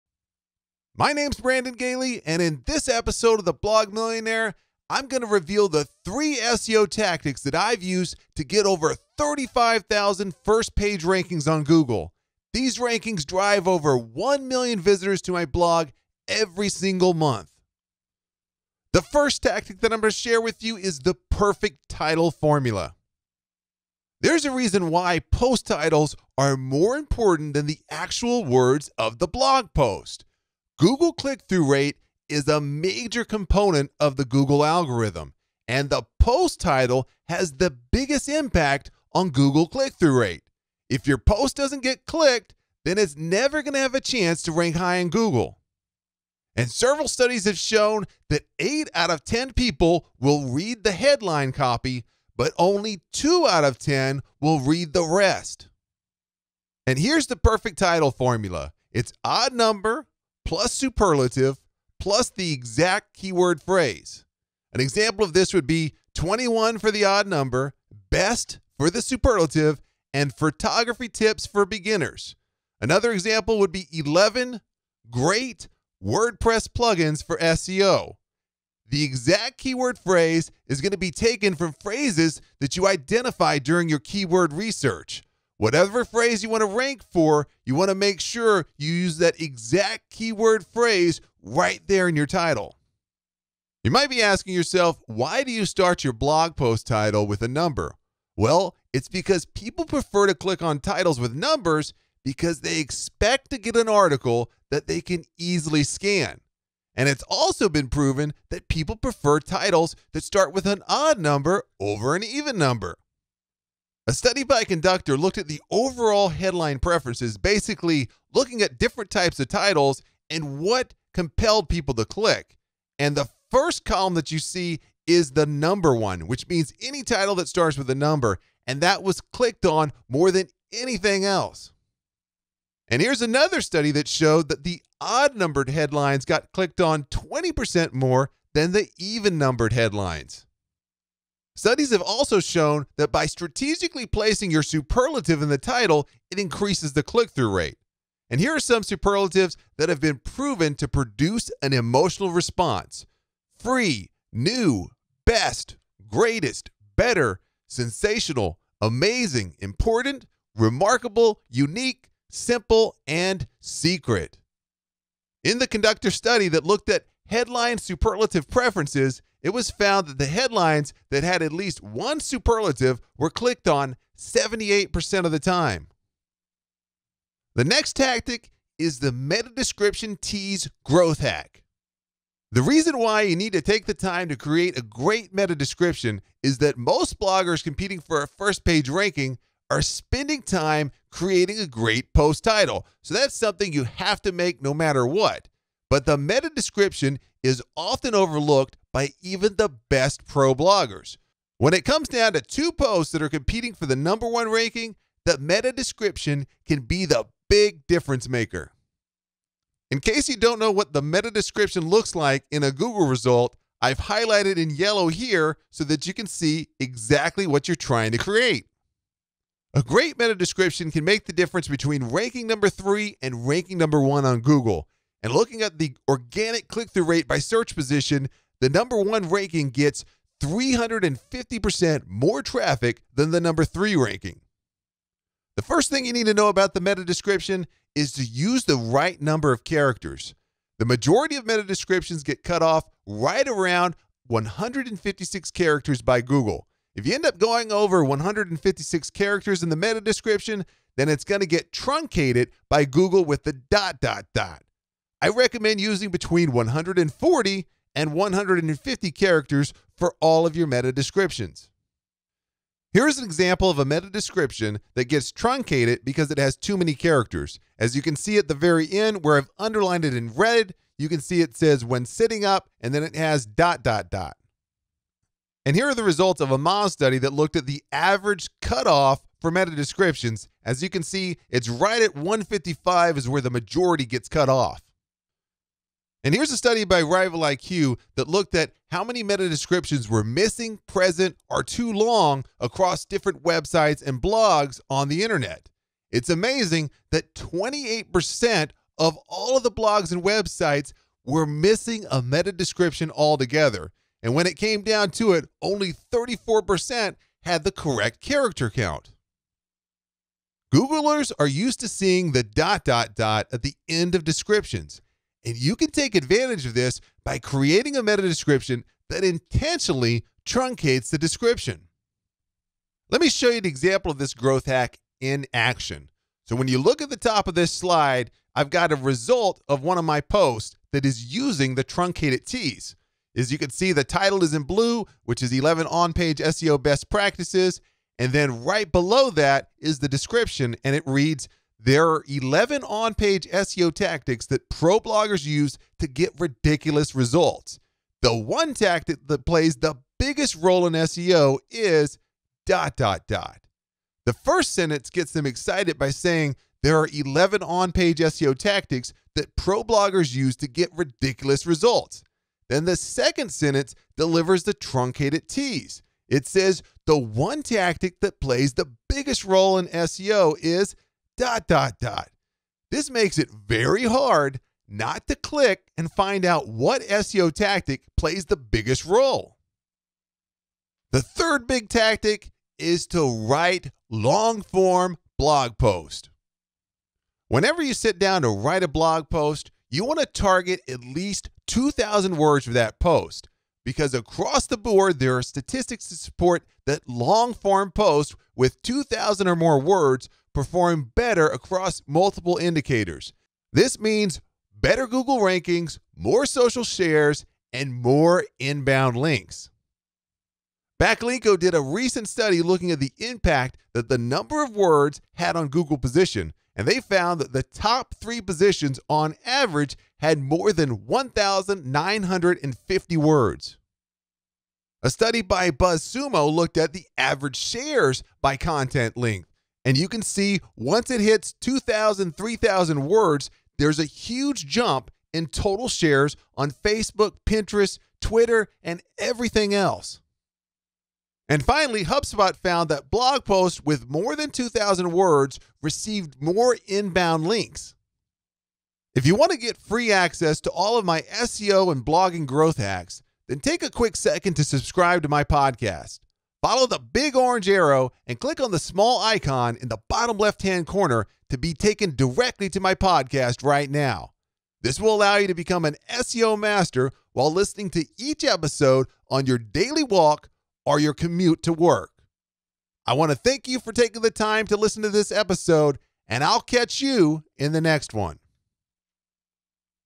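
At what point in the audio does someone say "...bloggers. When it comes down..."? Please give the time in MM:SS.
03:20.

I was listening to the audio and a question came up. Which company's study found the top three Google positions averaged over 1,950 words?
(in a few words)
Backlinko.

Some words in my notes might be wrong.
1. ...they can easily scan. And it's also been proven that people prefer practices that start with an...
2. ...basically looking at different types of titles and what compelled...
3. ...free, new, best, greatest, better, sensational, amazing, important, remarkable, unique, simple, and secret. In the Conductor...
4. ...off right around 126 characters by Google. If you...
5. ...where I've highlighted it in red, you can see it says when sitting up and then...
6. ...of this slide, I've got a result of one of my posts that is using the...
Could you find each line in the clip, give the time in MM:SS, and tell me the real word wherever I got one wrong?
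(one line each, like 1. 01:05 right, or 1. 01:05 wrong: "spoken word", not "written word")
1. 01:44 wrong: "titles", not "practices"
2. 01:57 right
3. 02:33 right
4. 04:02 wrong: "156", not "126"
5. 04:29 wrong: "underlined", not "highlighted"
6. 05:27 right.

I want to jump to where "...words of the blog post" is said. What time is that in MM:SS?
00:28.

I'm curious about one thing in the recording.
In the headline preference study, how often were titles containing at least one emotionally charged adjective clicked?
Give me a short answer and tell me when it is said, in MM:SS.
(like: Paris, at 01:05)
78%, at 02:54.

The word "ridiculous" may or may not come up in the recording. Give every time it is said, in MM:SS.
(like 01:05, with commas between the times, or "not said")
05:46, 06:00.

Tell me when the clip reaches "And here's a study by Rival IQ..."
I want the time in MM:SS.
04:46.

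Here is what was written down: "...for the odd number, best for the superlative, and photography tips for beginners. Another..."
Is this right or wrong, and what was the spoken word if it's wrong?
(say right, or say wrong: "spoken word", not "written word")
right.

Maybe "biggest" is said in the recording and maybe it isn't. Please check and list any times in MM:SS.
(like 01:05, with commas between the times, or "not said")
00:37, 05:50, 06:09, 06:18.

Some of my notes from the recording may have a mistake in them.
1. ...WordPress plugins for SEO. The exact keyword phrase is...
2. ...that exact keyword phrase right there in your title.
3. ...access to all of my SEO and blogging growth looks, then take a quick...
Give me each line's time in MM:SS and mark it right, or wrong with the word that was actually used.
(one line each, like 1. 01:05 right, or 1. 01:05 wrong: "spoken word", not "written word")
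1. 01:16 right
2. 01:29 right
3. 07:30 wrong: "hacks", not "looks".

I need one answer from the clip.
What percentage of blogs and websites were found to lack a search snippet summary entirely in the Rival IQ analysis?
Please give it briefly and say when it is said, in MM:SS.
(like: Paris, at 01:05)
28%, at 04:57.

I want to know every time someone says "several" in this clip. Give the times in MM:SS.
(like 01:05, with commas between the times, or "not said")
00:46.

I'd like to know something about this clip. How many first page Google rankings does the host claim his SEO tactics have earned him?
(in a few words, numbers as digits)
35,000.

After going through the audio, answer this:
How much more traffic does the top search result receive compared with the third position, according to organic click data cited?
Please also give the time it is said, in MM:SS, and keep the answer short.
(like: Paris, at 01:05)
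350%, at 03:50.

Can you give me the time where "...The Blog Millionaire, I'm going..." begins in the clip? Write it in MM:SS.
00:03.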